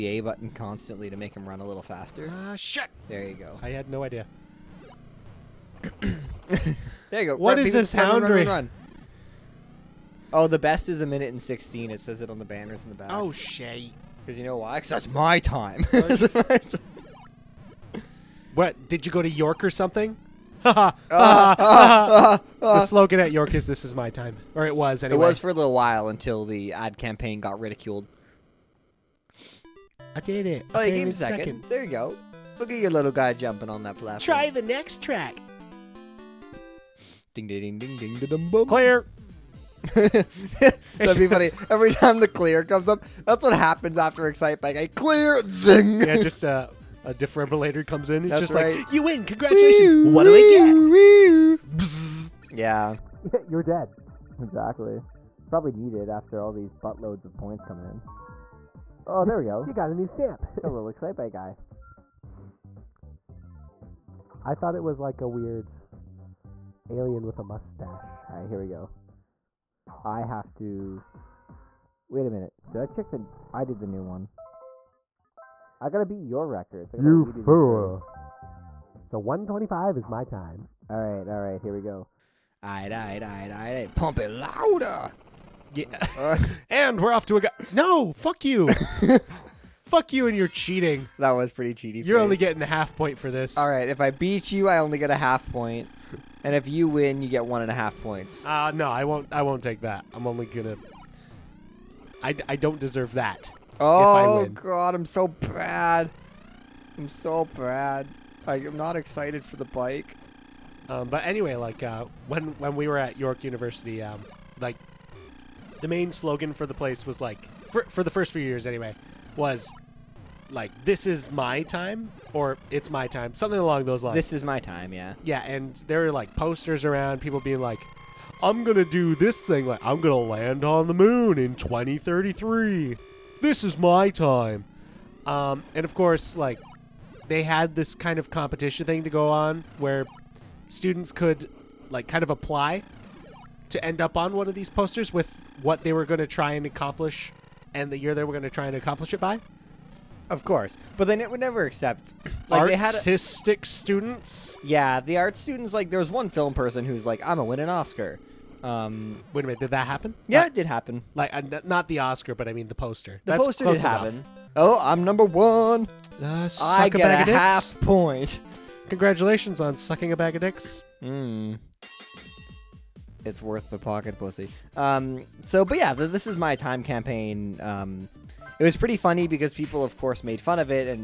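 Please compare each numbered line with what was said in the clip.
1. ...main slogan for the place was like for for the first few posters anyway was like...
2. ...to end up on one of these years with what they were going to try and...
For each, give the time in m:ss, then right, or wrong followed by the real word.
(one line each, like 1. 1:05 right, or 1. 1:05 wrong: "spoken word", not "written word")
1. 1:55 wrong: "years", not "posters"
2. 2:23 wrong: "posters", not "years".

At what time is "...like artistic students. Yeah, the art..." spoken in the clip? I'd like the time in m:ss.
2:32.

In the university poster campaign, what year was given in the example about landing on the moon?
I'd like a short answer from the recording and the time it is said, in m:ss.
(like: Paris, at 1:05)
2033, at 2:11.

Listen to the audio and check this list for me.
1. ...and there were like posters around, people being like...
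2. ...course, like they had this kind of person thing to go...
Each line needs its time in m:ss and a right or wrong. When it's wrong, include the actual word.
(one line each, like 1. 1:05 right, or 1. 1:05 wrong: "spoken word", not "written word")
1. 2:05 right
2. 2:15 wrong: "competition", not "person".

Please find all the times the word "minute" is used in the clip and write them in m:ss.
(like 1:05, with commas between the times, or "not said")
0:11, 1:12, 2:39.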